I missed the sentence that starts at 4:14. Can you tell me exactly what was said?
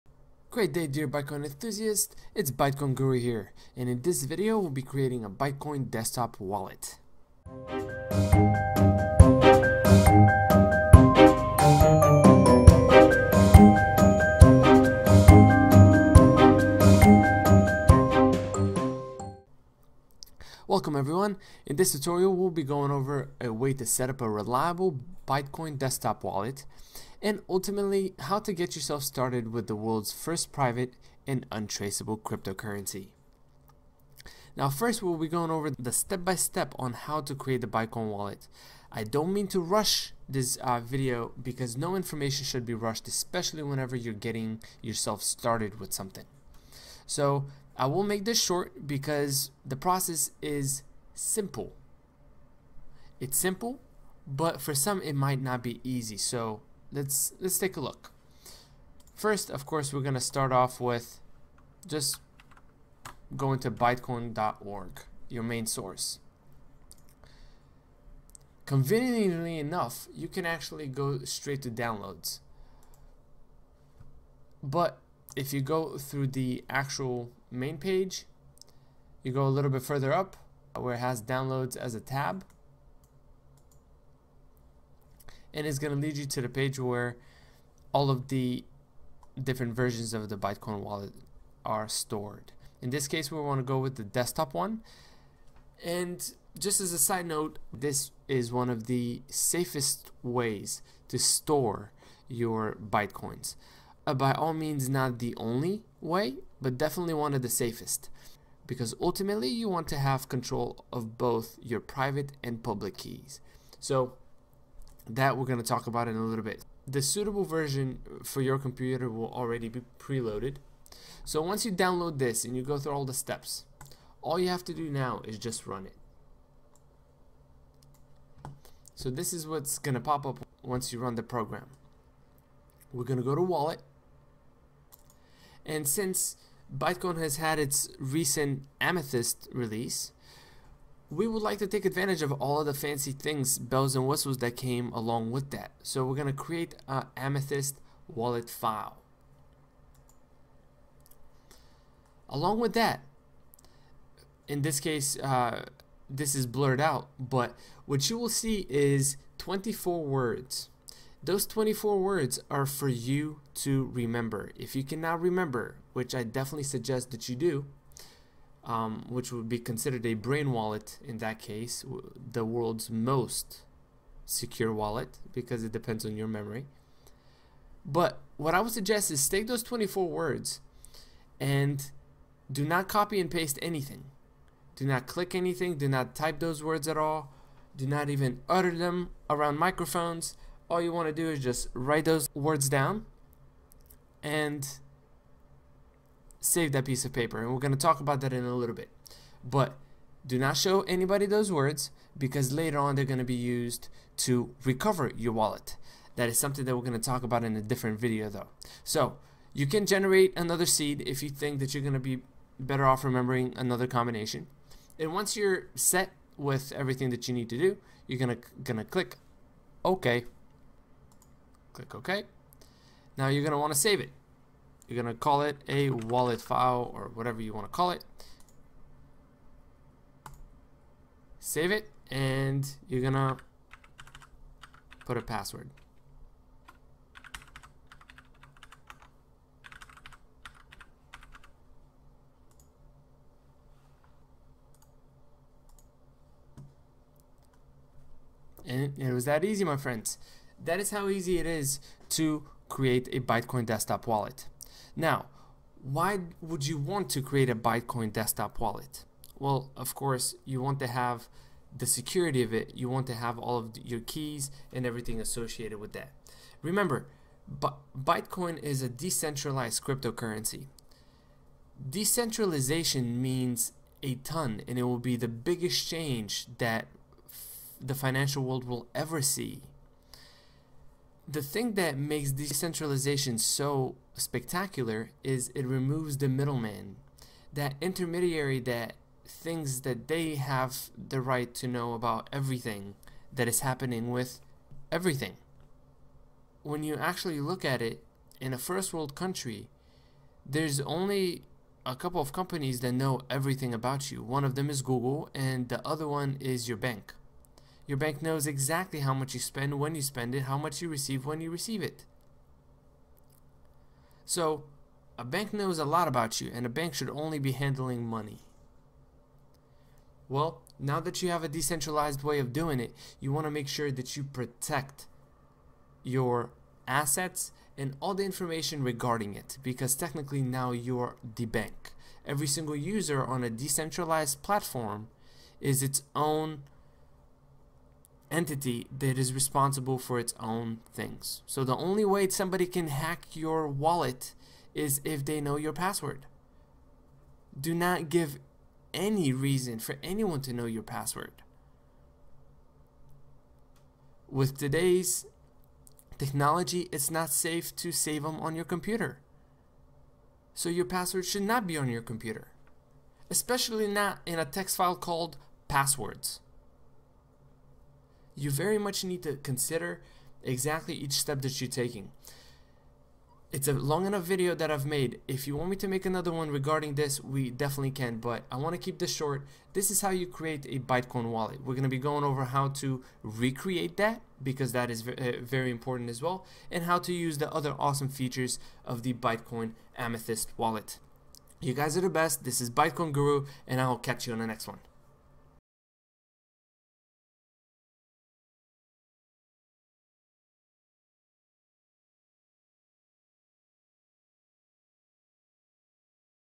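Now, why would you want to create a Bytecoin desktop wallet?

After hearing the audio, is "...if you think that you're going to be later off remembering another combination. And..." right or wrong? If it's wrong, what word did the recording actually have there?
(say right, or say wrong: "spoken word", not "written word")
wrong: "better", not "later".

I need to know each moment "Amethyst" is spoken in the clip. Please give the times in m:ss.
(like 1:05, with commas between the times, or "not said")
2:18, 2:27, 6:29.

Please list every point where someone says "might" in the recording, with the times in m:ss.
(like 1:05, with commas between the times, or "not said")
0:55.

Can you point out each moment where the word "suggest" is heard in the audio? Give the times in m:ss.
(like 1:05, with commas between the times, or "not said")
2:46, 2:58.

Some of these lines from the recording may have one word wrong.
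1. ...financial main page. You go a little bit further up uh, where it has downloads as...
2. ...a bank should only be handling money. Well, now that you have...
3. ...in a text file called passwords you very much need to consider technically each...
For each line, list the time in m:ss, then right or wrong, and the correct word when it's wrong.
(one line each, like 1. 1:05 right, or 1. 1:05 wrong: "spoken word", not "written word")
1. 1:16 wrong: "actual", not "financial"
2. 5:16 right
3. 6:04 wrong: "exactly", not "technically".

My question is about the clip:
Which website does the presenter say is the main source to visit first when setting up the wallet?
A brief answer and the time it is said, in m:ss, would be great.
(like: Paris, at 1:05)
Bytecoin.org, at 1:03.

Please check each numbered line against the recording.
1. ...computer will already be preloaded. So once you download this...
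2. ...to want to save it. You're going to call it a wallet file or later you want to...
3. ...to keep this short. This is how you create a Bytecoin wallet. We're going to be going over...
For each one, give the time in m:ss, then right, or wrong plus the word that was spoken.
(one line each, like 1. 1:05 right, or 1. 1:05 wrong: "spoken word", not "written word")
1. 1:58 right
2. 3:43 wrong: "whatever", not "later"
3. 6:18 right.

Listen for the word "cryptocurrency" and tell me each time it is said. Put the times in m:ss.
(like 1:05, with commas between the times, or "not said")
0:32, 4:29.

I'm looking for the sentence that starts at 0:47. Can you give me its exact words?
So I will make this short because the process is simple.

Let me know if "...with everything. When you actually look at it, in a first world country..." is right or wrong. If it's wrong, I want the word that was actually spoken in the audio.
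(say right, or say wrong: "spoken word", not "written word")
right.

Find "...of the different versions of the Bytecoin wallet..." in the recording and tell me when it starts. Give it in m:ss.
1:28.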